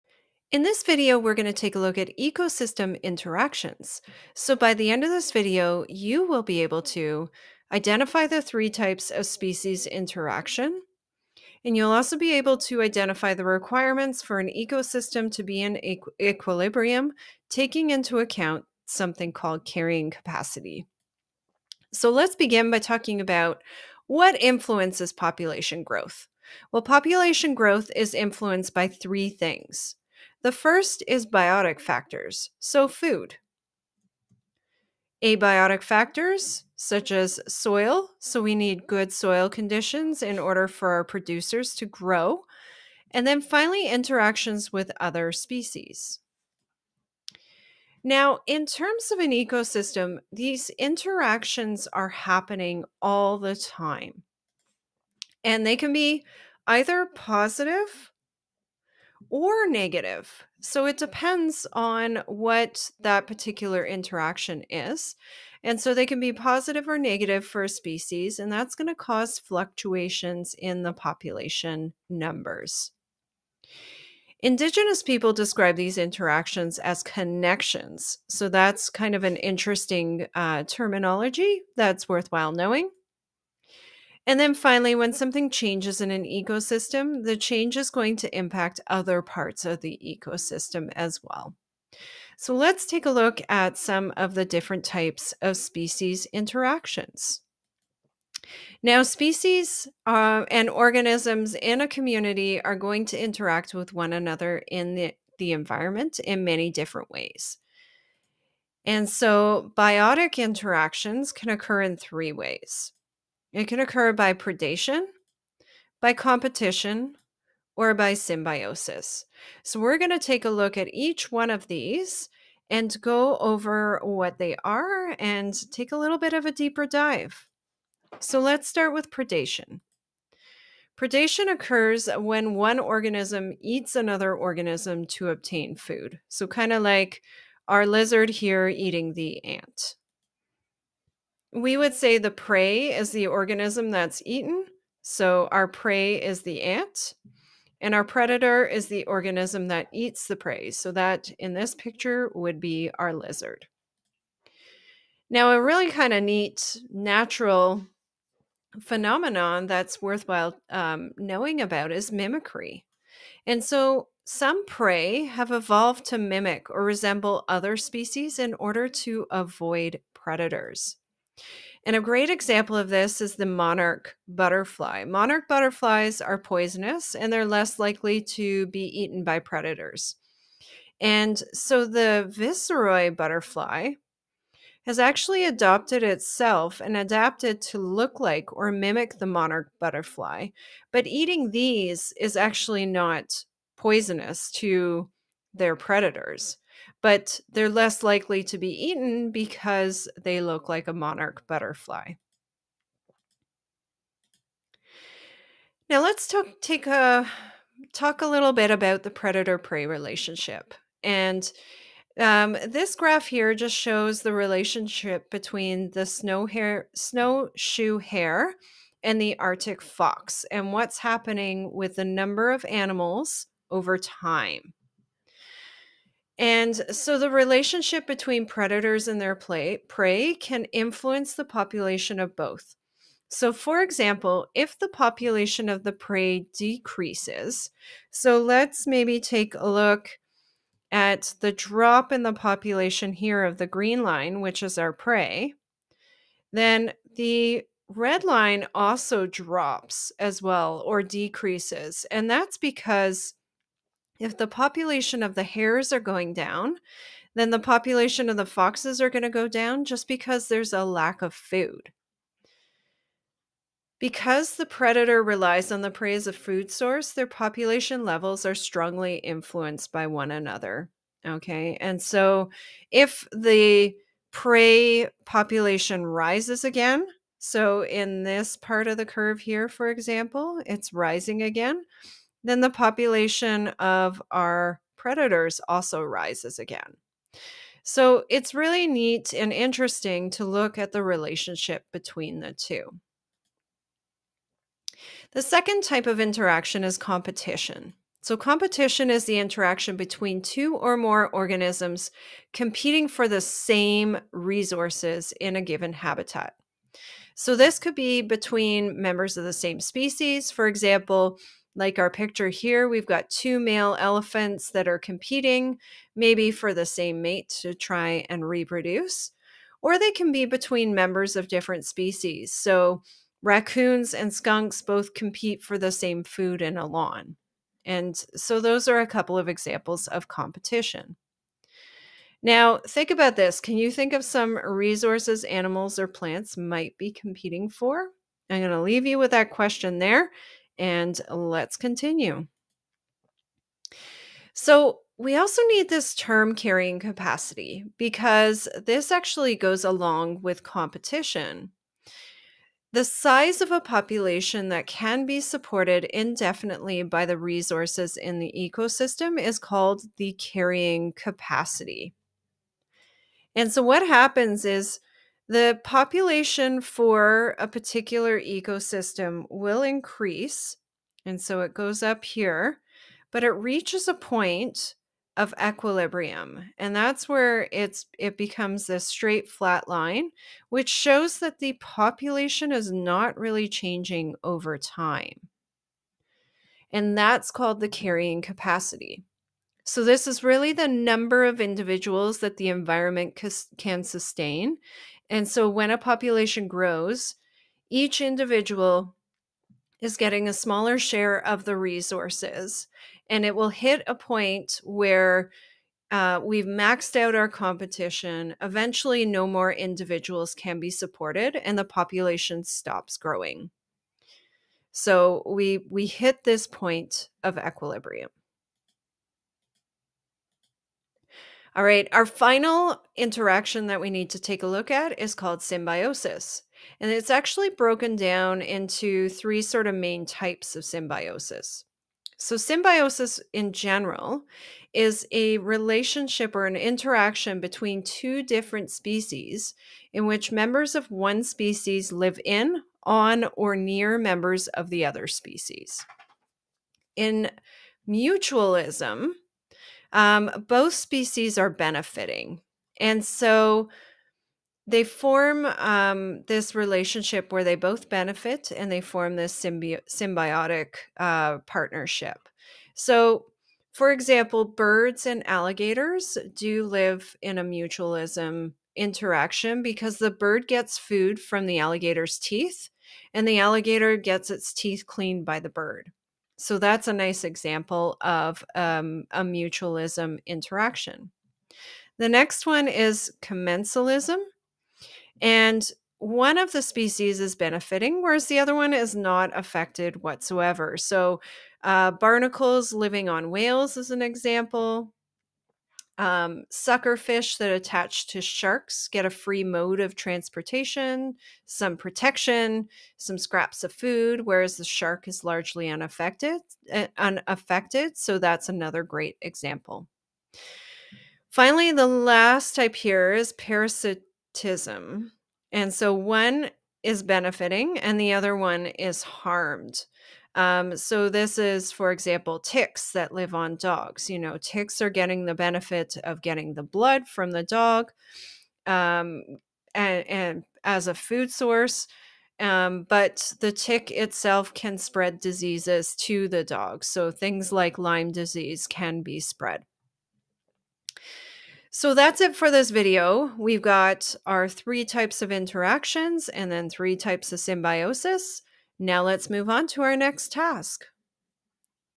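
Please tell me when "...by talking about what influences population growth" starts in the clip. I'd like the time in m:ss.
0:22.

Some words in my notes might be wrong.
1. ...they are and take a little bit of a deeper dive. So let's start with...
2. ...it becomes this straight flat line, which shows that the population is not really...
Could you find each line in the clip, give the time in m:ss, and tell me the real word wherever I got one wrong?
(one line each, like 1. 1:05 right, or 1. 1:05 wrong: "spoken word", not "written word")
1. 2:04 right
2. 6:18 right.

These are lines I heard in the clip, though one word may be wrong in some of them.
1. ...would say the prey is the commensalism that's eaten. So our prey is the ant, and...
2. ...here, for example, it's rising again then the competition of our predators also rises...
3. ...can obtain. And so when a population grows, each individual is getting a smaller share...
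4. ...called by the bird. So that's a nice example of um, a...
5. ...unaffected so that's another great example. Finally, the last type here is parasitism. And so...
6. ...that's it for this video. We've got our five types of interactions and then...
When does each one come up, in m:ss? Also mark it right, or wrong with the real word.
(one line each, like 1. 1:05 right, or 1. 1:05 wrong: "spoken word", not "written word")
1. 2:21 wrong: "organism", not "commensalism"
2. 4:39 wrong: "population", not "competition"
3. 6:33 wrong: "sustain", not "obtain"
4. 7:55 wrong: "cleaned", not "called"
5. 8:27 right
6. 9:02 wrong: "three", not "five".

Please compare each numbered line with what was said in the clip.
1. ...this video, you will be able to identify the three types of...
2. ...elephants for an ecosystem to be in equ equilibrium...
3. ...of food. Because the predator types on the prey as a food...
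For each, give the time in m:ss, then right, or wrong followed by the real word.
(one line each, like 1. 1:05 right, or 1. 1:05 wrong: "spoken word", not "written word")
1. 0:05 right
2. 0:13 wrong: "requirements", not "elephants"
3. 4:21 wrong: "relies", not "types".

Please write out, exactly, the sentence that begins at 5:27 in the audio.
And so those are a couple of examples of competition.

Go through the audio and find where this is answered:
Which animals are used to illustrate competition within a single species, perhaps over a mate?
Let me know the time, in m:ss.
5:13.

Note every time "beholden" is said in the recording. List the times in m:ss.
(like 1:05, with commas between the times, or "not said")
not said.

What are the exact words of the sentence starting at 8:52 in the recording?
Um, but the tick itself can spread diseases to the dog.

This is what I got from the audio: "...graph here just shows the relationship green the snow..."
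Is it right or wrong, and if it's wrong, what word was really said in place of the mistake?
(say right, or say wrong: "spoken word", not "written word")
wrong: "between", not "green".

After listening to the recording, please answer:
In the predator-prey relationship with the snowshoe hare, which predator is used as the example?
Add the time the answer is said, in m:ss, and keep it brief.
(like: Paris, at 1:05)
Arctic fox, at 3:39.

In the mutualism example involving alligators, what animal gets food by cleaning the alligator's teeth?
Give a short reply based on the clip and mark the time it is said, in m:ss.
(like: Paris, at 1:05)
birds, at 7:44.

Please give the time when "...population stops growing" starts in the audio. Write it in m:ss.
6:51.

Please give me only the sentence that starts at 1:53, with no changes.
It can occur by predation, by competition, or by symbiosis.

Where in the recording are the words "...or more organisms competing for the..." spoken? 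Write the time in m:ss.
5:00.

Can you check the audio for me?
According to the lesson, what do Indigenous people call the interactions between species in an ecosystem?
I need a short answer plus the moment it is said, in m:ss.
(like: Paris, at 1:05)
connections, at 1:17.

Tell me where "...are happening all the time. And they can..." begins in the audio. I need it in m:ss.
0:51.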